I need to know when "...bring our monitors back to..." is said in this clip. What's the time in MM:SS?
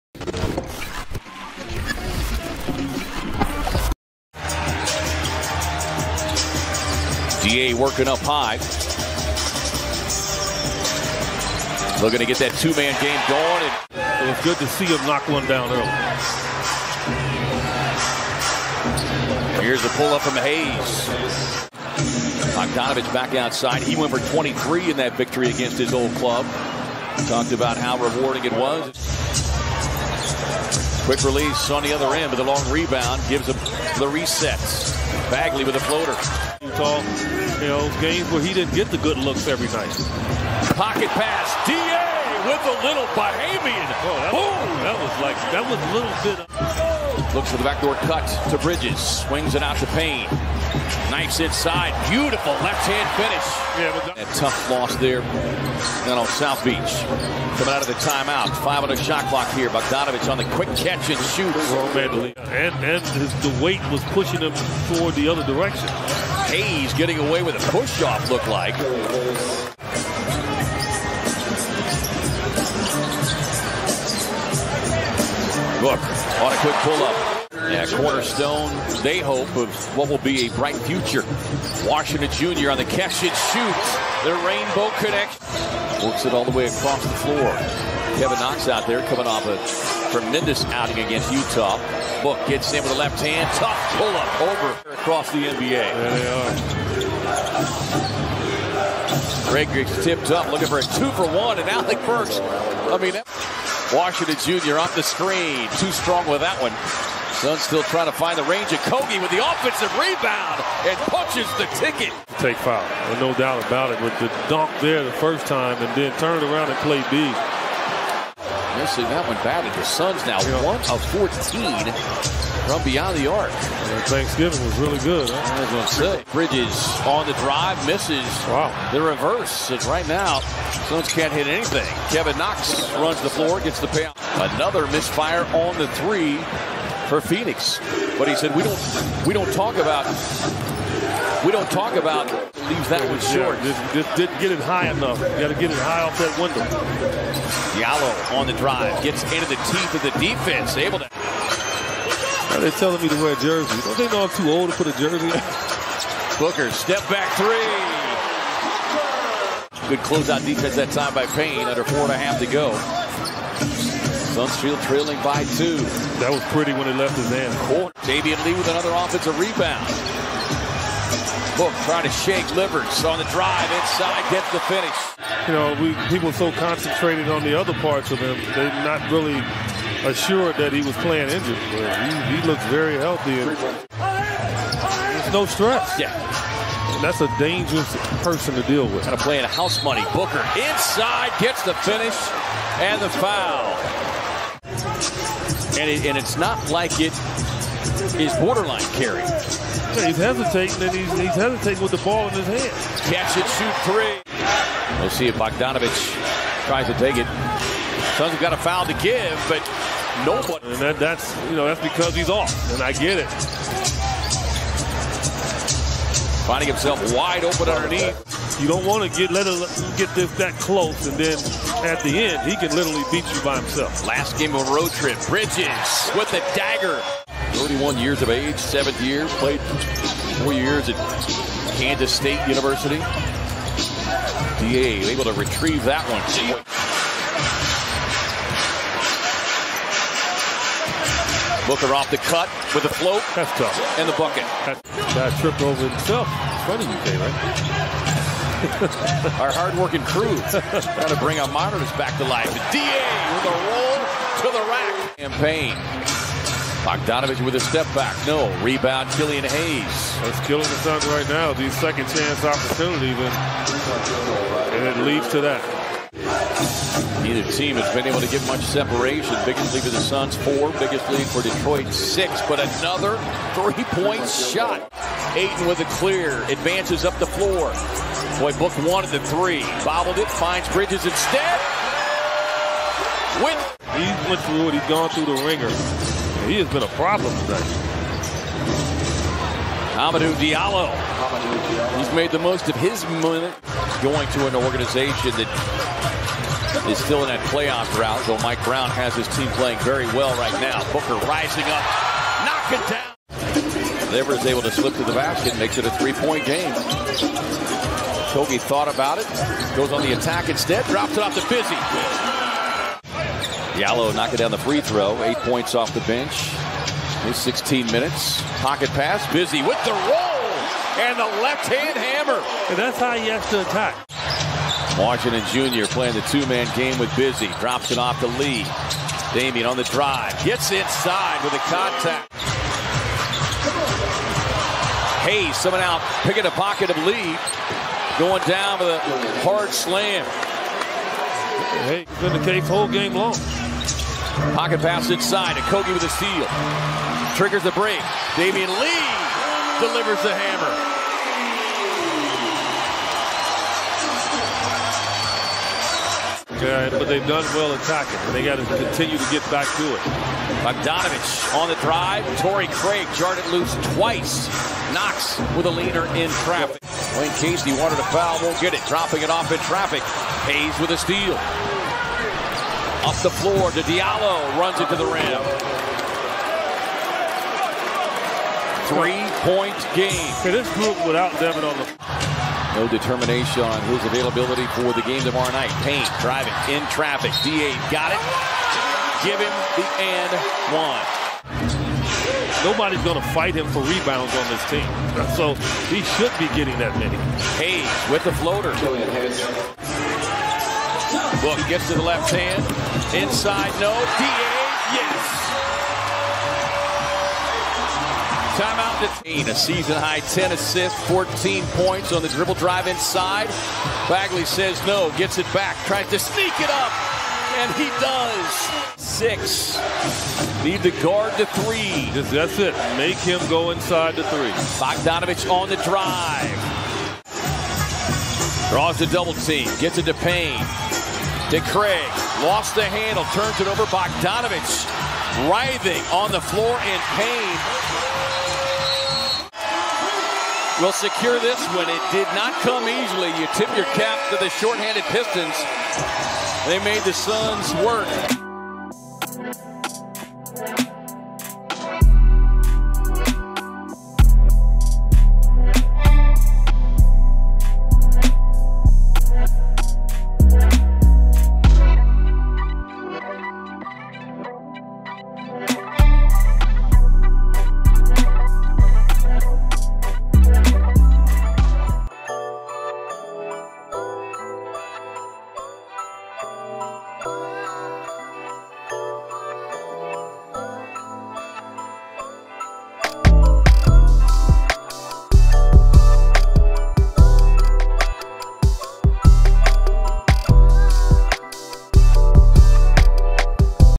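04:11.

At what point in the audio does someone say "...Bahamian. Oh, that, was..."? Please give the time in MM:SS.
00:43.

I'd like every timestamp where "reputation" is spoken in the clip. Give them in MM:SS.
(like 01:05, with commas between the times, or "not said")
not said.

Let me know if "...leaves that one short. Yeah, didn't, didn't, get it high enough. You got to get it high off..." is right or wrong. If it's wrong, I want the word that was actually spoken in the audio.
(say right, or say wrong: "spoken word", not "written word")
right.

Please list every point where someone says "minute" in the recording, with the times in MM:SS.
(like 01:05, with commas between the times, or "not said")
04:53, 05:17.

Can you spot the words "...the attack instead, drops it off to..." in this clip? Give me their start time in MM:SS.
05:10.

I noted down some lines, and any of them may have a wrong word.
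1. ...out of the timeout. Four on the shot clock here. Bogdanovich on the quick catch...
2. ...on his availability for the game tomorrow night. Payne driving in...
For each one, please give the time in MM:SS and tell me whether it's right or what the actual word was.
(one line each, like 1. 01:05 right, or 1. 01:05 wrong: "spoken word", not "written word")
1. 00:57 wrong: "Five", not "Four"
2. 06:23 right.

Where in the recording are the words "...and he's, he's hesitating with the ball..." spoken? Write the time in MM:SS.
03:20.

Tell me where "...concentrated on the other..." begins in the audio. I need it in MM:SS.
02:56.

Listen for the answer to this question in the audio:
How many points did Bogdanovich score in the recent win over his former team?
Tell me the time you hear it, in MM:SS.
00:24.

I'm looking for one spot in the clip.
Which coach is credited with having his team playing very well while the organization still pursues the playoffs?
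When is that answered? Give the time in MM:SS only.
04:58.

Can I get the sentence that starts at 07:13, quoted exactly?
Bogdanovich writhing on the floor in pain will secure this one.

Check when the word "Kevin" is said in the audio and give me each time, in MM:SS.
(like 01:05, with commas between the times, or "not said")
01:28, 02:12.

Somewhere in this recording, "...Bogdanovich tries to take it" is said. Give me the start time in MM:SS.
03:25.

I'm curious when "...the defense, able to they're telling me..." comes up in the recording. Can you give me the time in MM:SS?
02:30.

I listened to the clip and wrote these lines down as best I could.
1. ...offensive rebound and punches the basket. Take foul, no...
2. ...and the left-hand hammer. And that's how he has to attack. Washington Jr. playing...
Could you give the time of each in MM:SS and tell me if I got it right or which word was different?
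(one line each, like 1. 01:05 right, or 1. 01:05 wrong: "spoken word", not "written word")
1. 01:49 wrong: "ticket", not "basket"
2. 05:21 right.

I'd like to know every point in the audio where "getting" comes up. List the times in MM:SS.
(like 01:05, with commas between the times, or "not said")
01:06, 06:36.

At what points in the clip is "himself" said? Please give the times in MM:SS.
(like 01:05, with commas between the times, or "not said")
03:36, 03:43, 04:05.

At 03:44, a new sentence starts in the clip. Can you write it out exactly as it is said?
Last game of road trip, Bridges with the dagger.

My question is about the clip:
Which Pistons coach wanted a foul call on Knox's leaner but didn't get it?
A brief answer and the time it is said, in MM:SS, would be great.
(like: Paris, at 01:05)
Dwane Casey, at 06:06.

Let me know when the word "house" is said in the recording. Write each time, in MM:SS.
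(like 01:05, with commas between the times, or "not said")
03:09.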